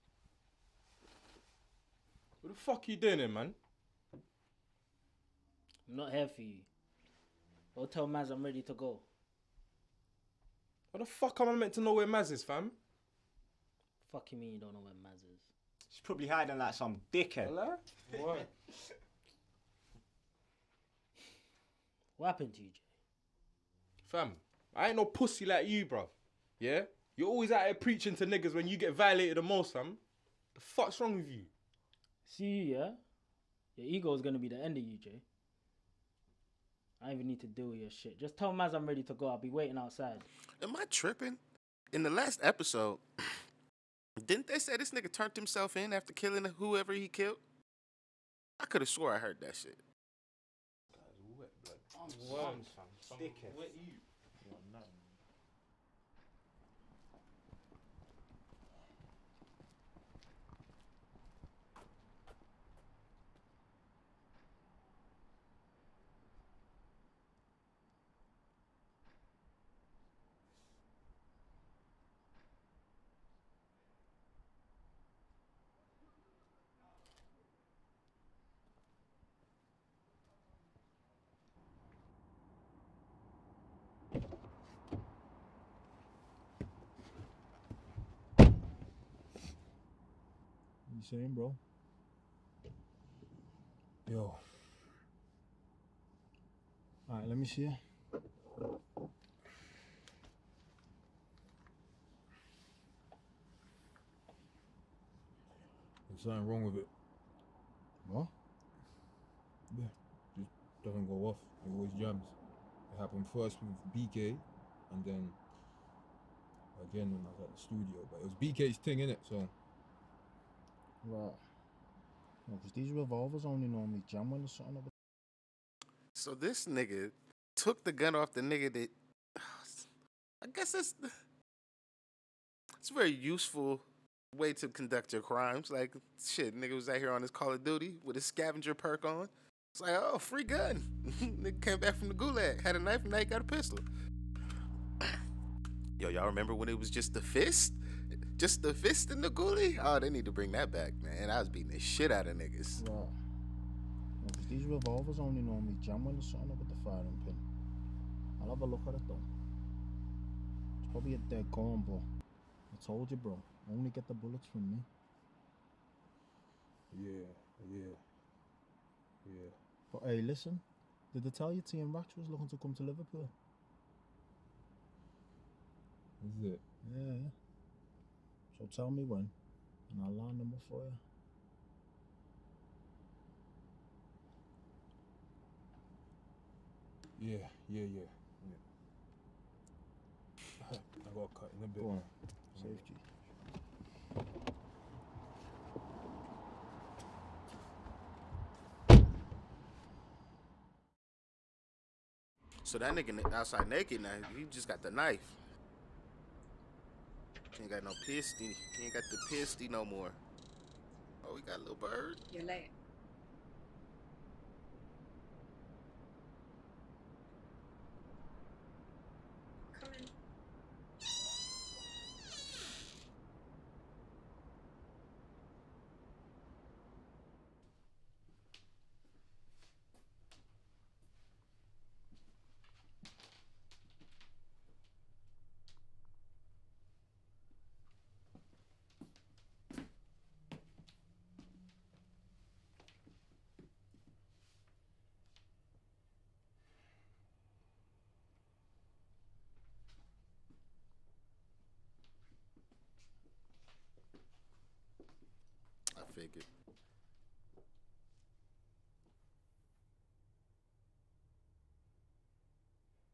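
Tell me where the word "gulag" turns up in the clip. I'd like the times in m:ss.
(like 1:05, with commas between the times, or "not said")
2:22.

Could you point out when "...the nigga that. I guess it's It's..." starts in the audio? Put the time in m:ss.
2:08.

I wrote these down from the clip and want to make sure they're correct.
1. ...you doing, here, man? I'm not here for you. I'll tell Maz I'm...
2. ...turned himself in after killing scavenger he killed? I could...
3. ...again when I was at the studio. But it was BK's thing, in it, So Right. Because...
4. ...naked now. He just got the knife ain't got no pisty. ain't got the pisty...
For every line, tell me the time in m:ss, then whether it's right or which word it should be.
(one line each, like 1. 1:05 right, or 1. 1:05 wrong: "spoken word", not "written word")
1. 0:02 right
2. 0:45 wrong: "whoever", not "scavenger"
3. 1:56 right
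4. 3:23 right.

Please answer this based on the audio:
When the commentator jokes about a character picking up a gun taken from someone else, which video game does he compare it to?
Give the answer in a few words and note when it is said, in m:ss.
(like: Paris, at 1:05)
Call of Duty, at 2:17.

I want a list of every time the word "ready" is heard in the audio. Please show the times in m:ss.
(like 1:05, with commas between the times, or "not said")
0:08, 0:38.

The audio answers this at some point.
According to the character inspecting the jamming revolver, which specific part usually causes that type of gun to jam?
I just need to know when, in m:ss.
2:36.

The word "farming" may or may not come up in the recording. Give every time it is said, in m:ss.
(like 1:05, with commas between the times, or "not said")
not said.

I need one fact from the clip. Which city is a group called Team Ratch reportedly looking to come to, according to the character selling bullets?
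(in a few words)
Liverpool.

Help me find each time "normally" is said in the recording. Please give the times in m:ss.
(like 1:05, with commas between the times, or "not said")
2:03, 2:35.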